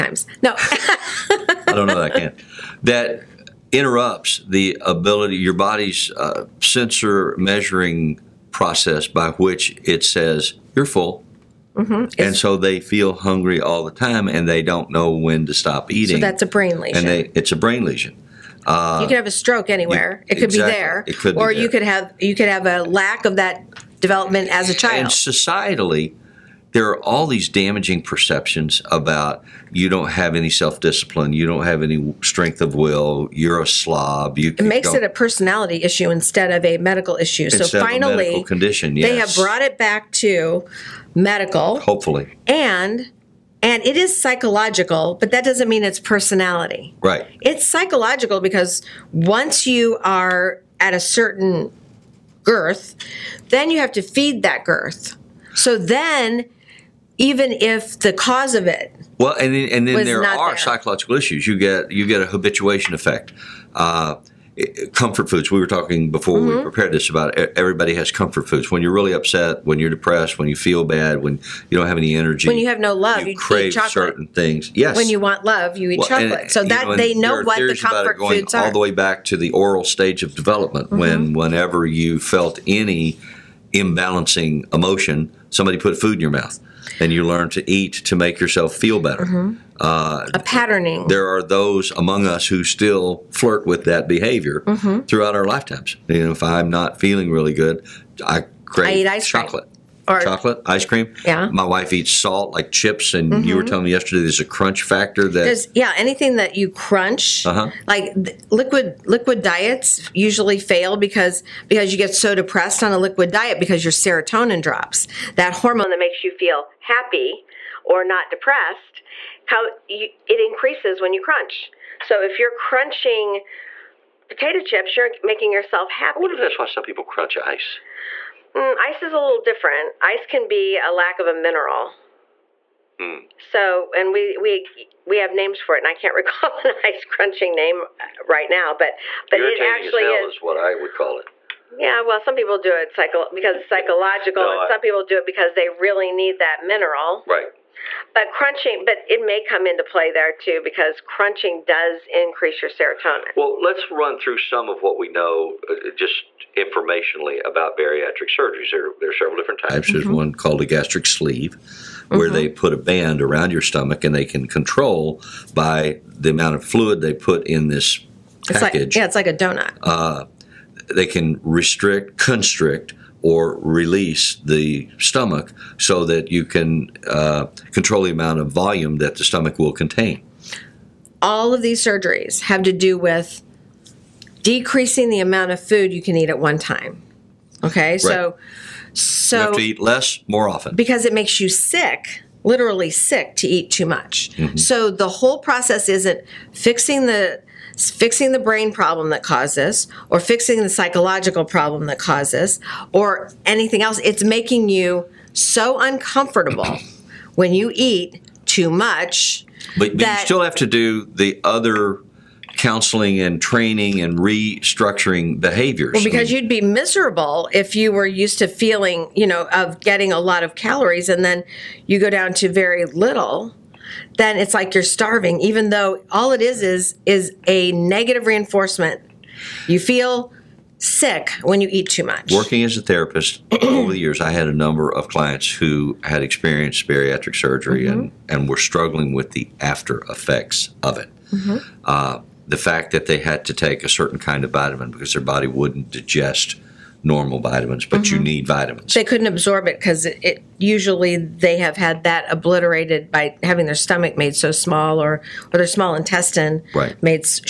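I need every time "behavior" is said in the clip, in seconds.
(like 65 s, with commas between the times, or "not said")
94 s, 215 s.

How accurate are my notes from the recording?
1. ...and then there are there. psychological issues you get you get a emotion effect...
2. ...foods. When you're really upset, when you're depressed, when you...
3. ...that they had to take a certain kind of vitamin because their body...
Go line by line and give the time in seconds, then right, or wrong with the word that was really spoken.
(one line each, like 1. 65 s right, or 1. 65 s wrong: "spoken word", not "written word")
1. 59 s wrong: "habituation", not "emotion"
2. 68 s right
3. 242 s right.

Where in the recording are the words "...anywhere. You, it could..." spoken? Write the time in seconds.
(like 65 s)
19 s.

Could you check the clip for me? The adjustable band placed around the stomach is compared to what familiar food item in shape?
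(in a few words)
donut.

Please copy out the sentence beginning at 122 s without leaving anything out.
So if you're crunching potato chips, you're making yourself happy.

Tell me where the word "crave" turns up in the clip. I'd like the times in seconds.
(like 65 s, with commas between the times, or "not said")
73 s, 98 s.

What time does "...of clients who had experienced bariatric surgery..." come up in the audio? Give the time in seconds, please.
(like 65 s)
234 s.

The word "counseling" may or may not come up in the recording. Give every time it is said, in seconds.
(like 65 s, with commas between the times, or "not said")
212 s.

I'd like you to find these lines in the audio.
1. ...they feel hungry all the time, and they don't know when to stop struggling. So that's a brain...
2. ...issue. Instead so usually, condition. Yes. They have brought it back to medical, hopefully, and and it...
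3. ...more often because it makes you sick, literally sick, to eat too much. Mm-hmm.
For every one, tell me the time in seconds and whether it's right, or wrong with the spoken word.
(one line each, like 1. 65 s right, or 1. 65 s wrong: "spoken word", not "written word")
1. 12 s wrong: "eating", not "struggling"
2. 37 s wrong: "finally", not "usually"
3. 190 s right.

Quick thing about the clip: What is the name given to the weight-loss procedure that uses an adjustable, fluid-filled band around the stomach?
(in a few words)
gastric sleeve.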